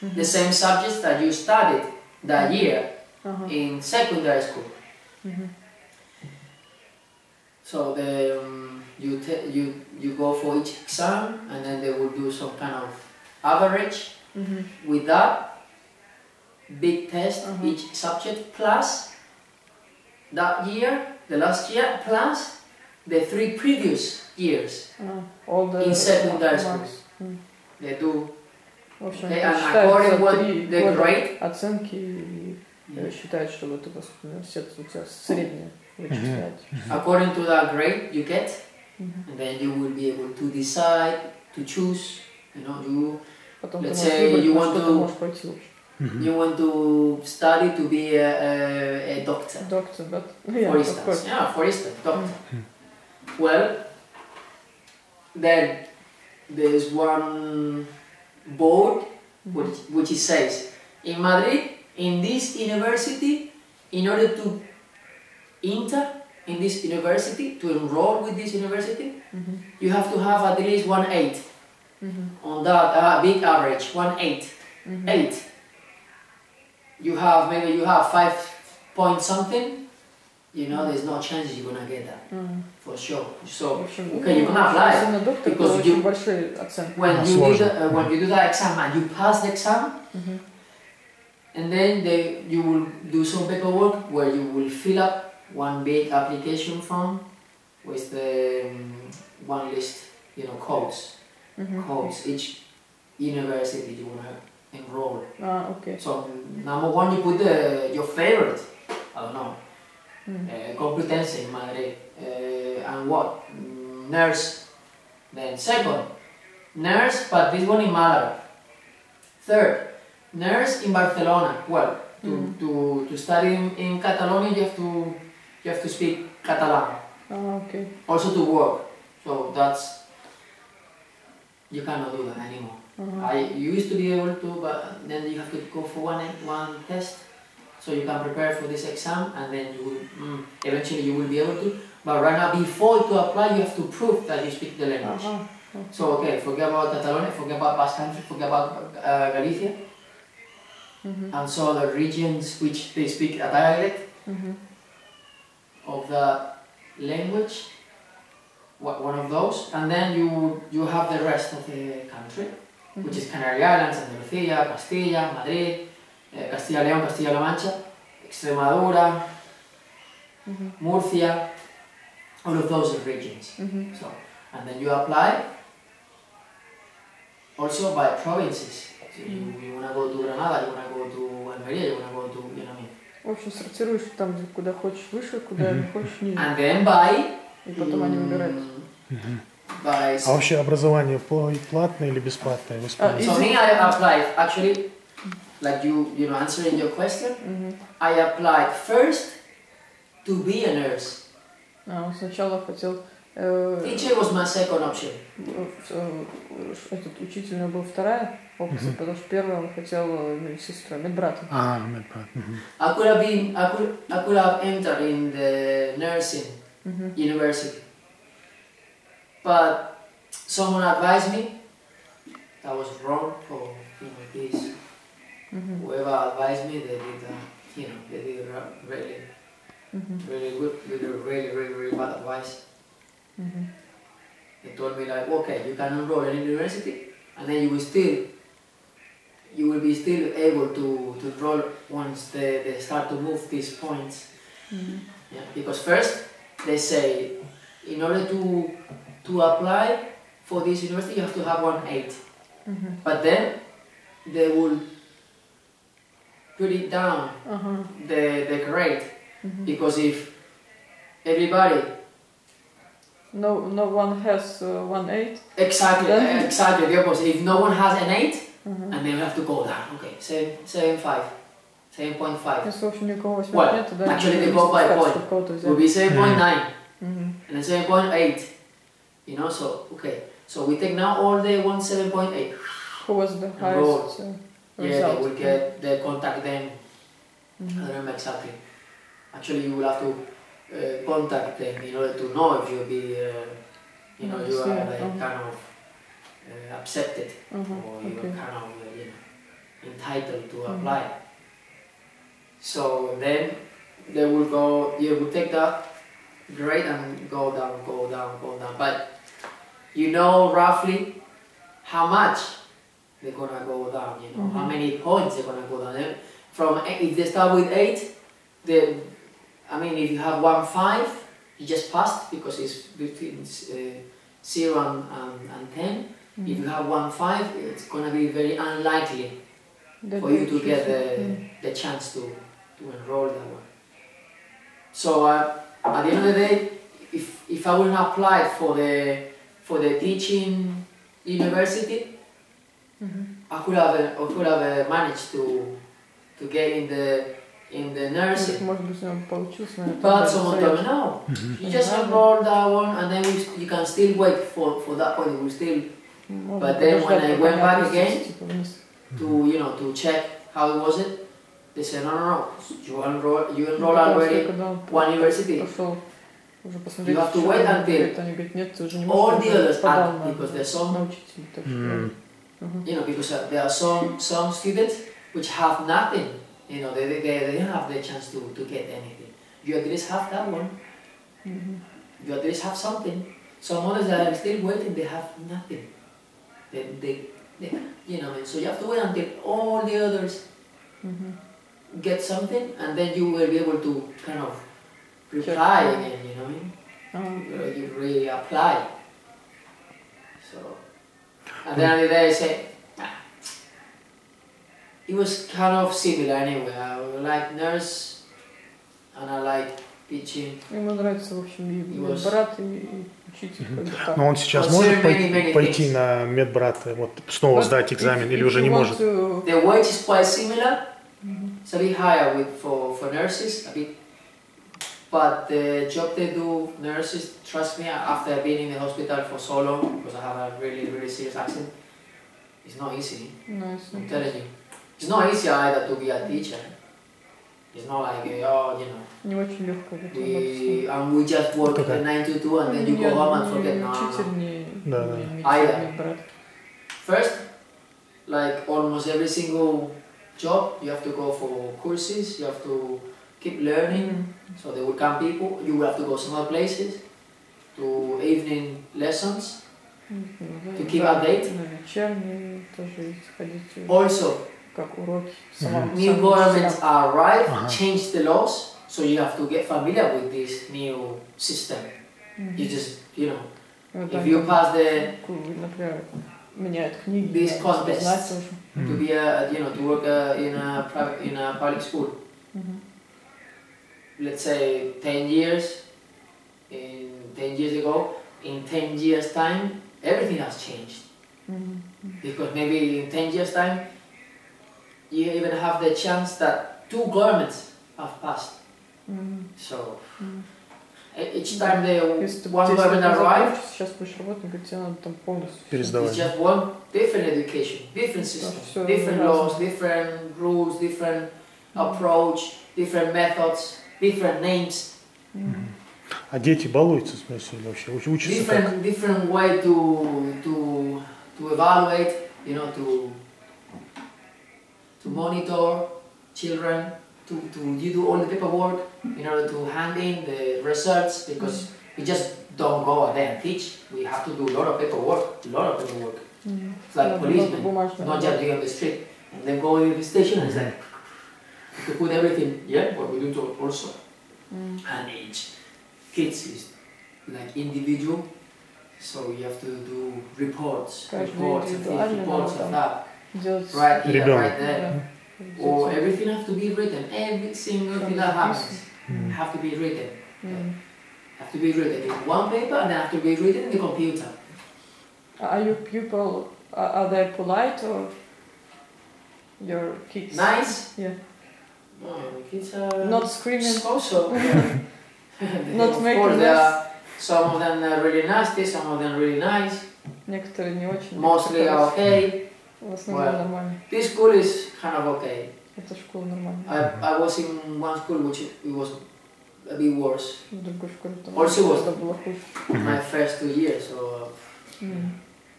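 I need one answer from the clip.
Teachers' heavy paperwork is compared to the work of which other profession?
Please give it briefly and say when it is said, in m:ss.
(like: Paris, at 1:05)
Policemen, at 8:56.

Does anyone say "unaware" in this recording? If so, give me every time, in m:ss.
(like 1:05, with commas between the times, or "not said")
not said.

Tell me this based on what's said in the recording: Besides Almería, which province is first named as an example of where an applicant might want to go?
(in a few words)
Granada.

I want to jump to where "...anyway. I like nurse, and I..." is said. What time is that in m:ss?
6:46.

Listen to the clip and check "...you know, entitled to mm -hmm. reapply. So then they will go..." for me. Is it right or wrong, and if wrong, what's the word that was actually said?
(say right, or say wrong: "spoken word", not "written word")
wrong: "apply", not "reapply".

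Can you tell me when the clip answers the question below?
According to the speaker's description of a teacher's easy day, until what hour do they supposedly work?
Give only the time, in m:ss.
7:22.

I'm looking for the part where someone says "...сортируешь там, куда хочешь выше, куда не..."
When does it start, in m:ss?
3:03.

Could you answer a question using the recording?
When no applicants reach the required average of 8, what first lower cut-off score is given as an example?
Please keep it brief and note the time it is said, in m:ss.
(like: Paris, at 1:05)
7.9, at 4:35.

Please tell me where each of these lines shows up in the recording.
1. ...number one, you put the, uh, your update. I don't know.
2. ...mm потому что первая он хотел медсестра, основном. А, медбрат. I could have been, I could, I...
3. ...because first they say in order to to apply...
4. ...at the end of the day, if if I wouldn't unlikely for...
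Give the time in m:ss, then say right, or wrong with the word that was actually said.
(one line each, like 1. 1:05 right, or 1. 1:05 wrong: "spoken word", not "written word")
1. 1:46 wrong: "favorite", not "update"
2. 3:28 wrong: "медбратом", not "основном"
3. 4:05 right
4. 5:35 wrong: "apply", not "unlikely".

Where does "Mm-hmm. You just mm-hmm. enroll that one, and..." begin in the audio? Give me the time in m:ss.
5:51.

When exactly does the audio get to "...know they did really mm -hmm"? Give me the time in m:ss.
3:47.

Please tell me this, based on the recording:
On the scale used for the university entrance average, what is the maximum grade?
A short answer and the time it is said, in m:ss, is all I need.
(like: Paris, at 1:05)
10, at 5:23.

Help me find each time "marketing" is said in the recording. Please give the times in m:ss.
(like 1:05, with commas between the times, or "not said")
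not said.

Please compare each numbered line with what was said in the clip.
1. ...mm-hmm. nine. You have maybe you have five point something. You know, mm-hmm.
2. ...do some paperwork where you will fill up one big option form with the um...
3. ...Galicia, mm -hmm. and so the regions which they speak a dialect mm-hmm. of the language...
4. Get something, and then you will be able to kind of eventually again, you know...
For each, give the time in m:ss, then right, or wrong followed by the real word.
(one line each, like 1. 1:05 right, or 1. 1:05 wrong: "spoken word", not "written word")
1. 1:14 wrong: "eight", not "nine"
2. 1:33 wrong: "application", not "option"
3. 2:29 right
4. 6:32 wrong: "reply", not "eventually".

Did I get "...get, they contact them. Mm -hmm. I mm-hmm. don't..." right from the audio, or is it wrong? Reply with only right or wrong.
right.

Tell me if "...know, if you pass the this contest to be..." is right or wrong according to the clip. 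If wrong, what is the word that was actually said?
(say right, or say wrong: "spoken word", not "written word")
right.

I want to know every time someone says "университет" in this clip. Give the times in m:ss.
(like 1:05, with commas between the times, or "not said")
0:34.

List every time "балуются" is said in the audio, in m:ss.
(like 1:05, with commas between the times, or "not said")
8:36.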